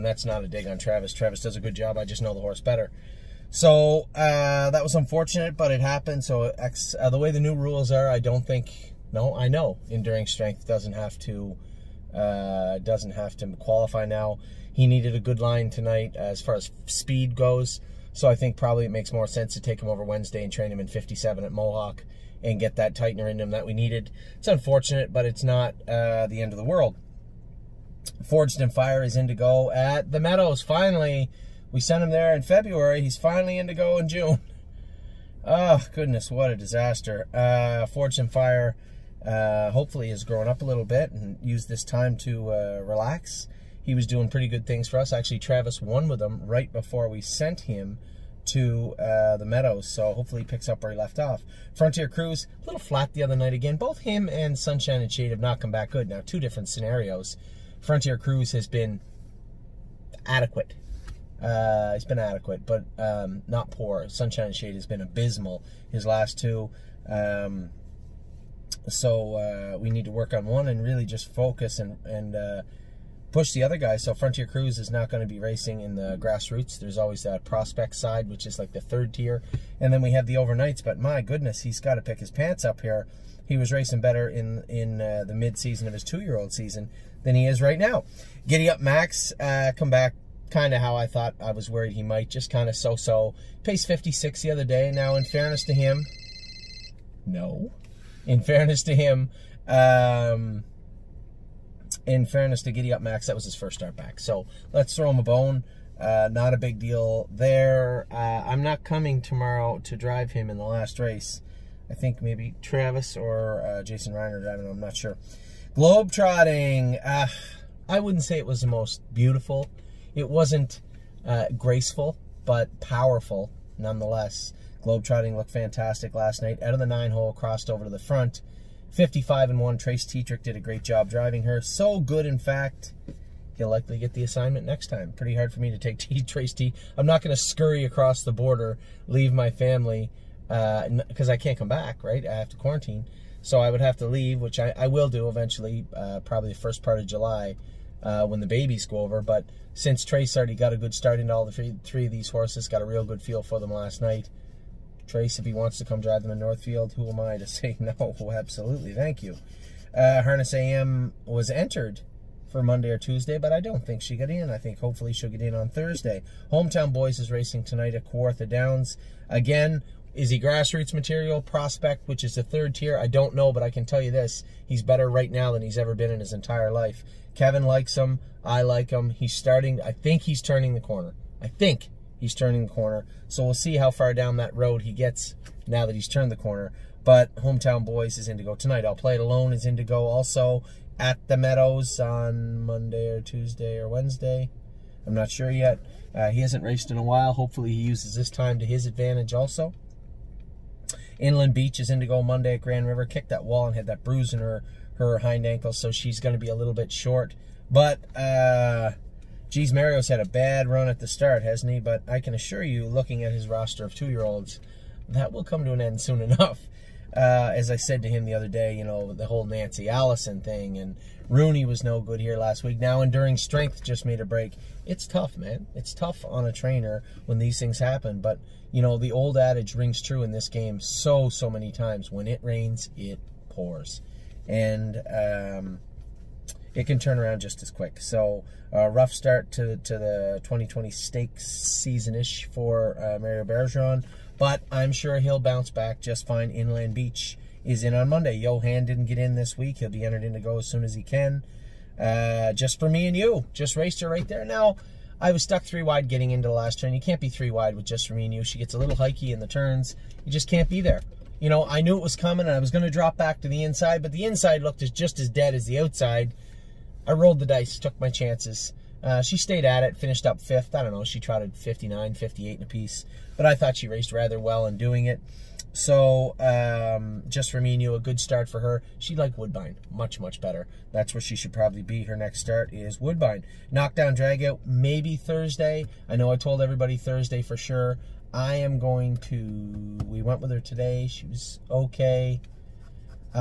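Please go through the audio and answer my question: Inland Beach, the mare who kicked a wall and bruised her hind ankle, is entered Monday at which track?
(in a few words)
Grand River.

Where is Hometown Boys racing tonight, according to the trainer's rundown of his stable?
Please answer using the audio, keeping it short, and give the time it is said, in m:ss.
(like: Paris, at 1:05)
Kawartha Downs, at 2:48.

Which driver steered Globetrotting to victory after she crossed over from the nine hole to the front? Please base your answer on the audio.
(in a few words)
Trace Tetrick.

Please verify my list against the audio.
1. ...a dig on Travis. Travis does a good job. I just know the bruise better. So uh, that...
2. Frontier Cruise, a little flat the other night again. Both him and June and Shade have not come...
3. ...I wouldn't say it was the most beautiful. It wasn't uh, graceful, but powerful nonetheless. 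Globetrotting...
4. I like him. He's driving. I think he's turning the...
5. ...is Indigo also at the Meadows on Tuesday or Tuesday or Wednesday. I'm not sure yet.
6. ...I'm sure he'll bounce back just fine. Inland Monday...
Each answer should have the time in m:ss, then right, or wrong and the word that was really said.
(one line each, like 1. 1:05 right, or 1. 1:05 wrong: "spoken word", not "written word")
1. 0:00 wrong: "horse", not "bruise"
2. 0:51 wrong: "Sunshine", not "June"
3. 1:57 right
4. 2:58 wrong: "starting", not "driving"
5. 3:09 wrong: "Monday", not "Tuesday"
6. 4:04 wrong: "Beach", not "Monday".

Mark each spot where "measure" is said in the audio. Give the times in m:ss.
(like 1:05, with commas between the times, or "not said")
not said.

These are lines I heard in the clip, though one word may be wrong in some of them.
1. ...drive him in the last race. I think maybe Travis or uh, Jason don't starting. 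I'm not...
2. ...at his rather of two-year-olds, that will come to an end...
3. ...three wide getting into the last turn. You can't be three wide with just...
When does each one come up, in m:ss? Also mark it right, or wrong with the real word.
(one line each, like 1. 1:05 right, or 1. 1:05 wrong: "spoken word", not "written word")
1. 1:49 wrong: "driving", not "starting"
2. 3:33 wrong: "roster", not "rather"
3. 4:15 right.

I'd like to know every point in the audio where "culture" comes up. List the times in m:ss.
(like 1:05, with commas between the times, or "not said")
not said.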